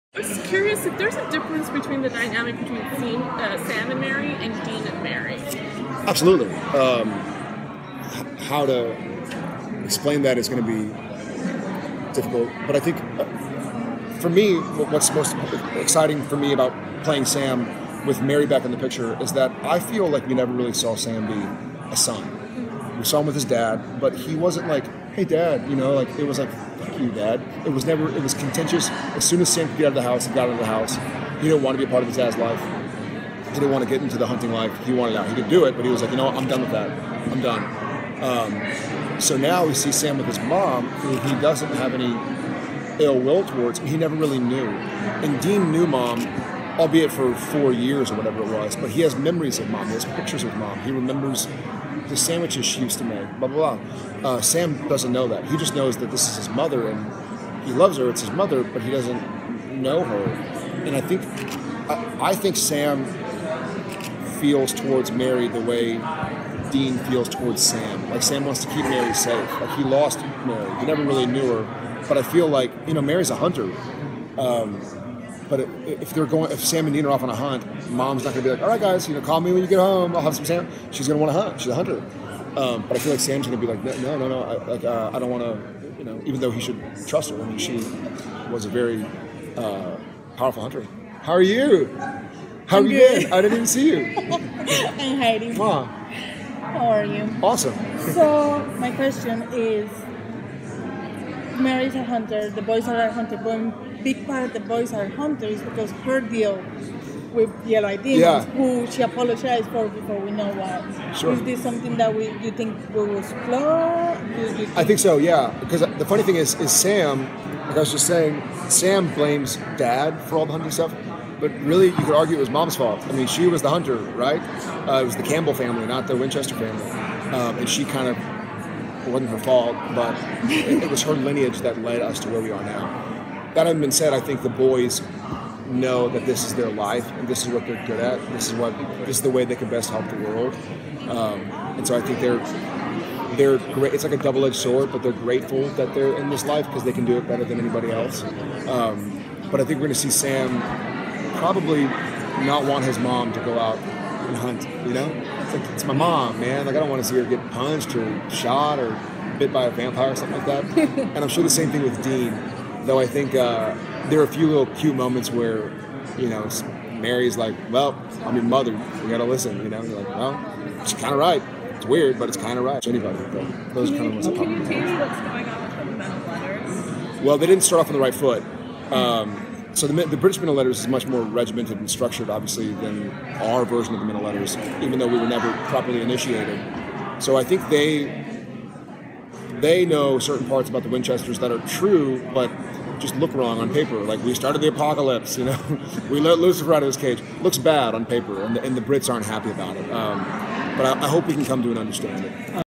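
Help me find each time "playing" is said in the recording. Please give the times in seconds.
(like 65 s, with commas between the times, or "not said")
17 s.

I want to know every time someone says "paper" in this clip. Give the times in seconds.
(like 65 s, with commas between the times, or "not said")
193 s, 198 s.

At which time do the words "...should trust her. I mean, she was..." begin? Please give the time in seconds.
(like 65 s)
86 s.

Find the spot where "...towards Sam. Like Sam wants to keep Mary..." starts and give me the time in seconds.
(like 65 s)
67 s.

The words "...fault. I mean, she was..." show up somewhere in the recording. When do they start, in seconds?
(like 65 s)
122 s.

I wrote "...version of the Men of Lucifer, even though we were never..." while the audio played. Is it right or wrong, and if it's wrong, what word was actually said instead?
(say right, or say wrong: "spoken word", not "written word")
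wrong: "Letters", not "Lucifer".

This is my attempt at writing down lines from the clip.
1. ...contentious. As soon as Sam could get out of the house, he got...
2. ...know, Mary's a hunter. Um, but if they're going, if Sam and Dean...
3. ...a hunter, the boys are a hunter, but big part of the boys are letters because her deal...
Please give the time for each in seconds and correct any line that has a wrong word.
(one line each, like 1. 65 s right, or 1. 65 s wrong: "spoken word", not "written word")
1. 28 s right
2. 72 s right
3. 101 s wrong: "hunters", not "letters".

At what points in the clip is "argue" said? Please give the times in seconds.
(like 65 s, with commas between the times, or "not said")
122 s.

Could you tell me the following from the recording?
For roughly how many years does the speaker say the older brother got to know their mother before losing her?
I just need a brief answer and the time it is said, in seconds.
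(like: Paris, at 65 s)
4, at 47 s.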